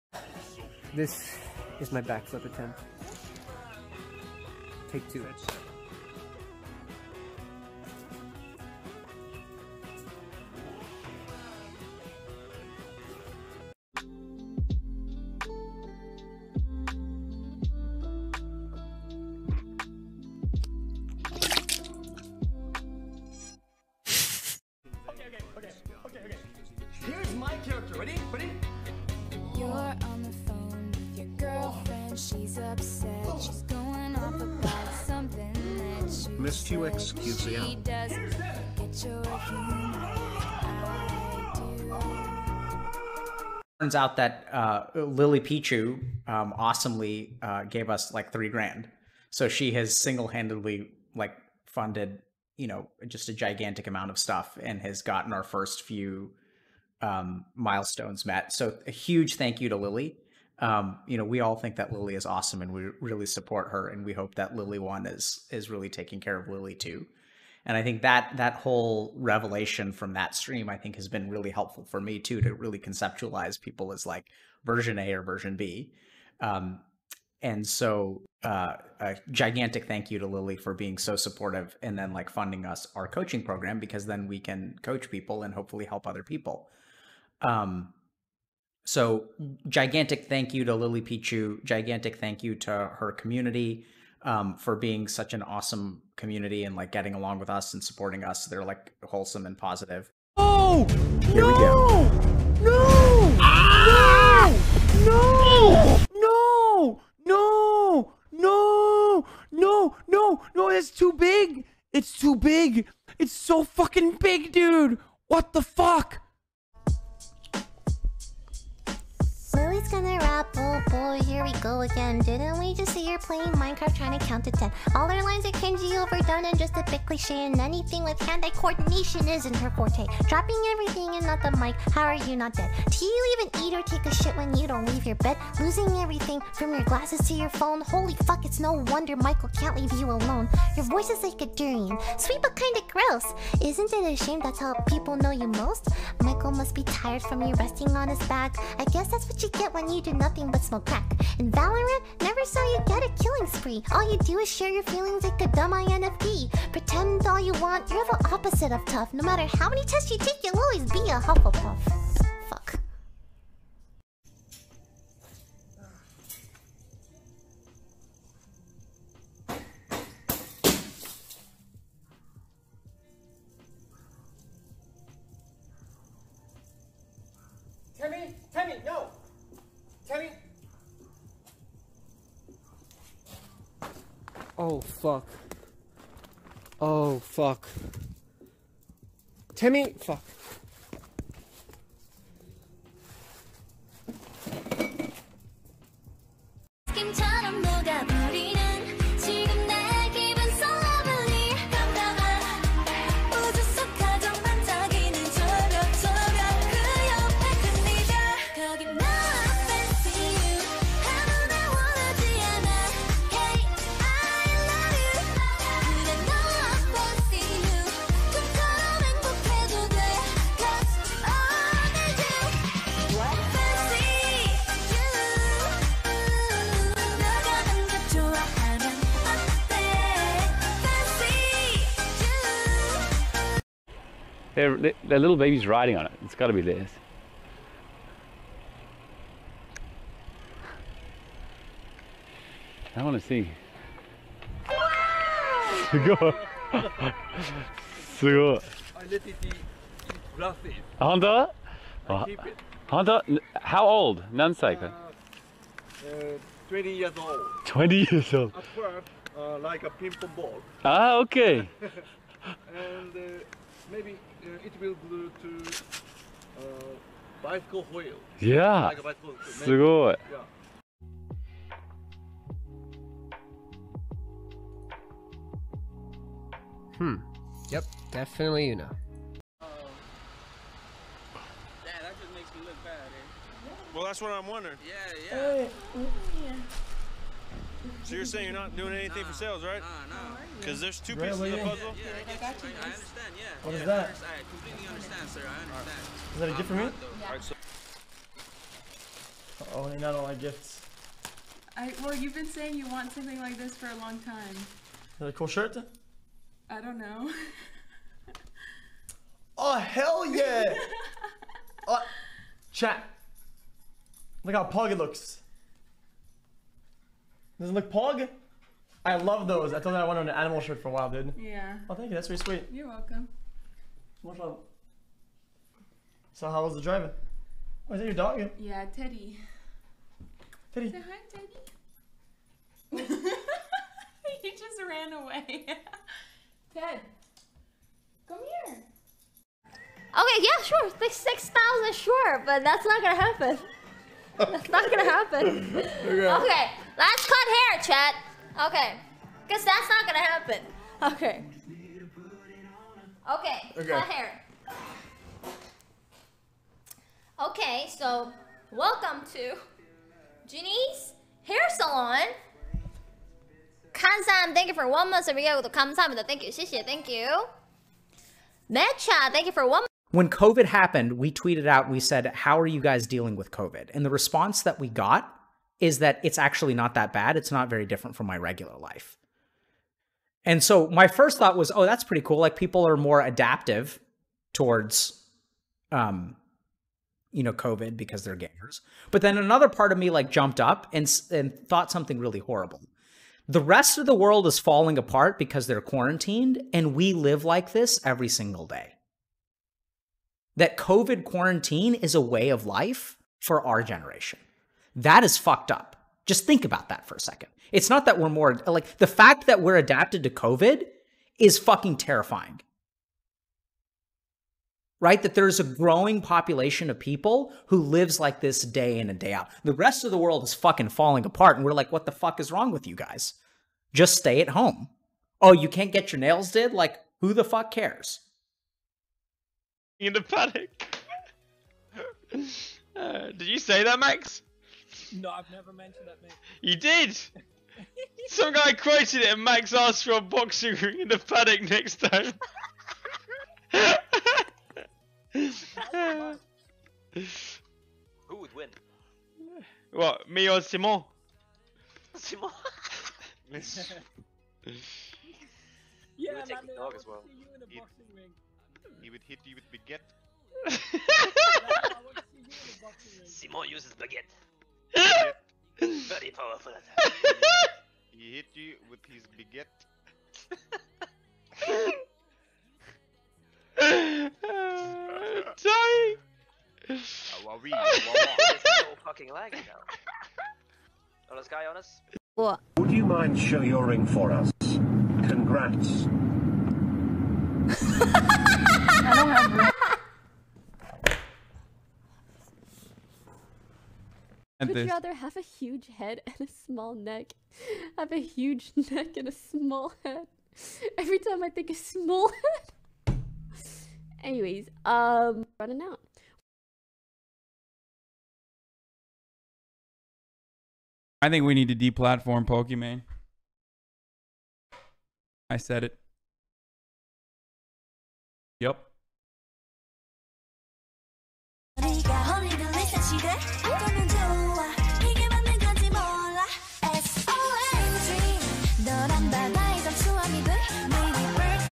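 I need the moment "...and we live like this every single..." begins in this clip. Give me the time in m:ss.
6:36.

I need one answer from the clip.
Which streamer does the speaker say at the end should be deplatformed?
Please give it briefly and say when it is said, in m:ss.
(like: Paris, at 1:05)
Pokimane, at 8:32.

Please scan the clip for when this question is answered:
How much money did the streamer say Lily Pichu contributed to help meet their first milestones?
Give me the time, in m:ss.
0:48.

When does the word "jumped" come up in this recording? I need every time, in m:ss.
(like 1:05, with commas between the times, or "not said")
6:30.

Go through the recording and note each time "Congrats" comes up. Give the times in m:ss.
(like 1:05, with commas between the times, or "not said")
8:04.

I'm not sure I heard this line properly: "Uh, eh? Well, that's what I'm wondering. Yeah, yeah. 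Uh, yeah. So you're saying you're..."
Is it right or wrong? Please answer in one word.
right.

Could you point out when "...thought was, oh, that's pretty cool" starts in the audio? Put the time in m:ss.
6:21.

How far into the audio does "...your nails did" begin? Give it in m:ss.
7:06.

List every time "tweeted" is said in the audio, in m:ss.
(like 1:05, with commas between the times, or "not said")
6:11.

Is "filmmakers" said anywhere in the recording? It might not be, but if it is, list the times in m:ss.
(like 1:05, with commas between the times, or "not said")
not said.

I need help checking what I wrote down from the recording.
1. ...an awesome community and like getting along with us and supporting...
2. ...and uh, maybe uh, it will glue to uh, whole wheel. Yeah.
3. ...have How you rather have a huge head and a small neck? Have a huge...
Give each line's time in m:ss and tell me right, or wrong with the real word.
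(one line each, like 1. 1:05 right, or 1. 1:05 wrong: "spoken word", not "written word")
1. 1:35 right
2. 4:21 wrong: "bicycle", not "whole"
3. 8:09 wrong: "Would", not "How".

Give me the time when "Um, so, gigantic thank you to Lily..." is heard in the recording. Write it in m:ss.
1:27.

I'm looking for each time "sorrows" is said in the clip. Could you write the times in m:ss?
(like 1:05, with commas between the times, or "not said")
not said.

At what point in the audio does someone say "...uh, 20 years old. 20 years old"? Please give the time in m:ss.
4:16.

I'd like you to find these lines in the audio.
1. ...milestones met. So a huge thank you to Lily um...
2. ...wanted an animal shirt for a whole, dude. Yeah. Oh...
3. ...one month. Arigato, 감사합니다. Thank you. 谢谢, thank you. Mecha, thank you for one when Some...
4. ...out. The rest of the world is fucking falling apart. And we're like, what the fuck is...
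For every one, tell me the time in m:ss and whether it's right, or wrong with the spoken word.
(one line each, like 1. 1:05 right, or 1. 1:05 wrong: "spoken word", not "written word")
1. 0:57 right
2. 5:20 wrong: "while", not "whole"
3. 6:04 wrong: "COVID", not "Some"
4. 6:59 right.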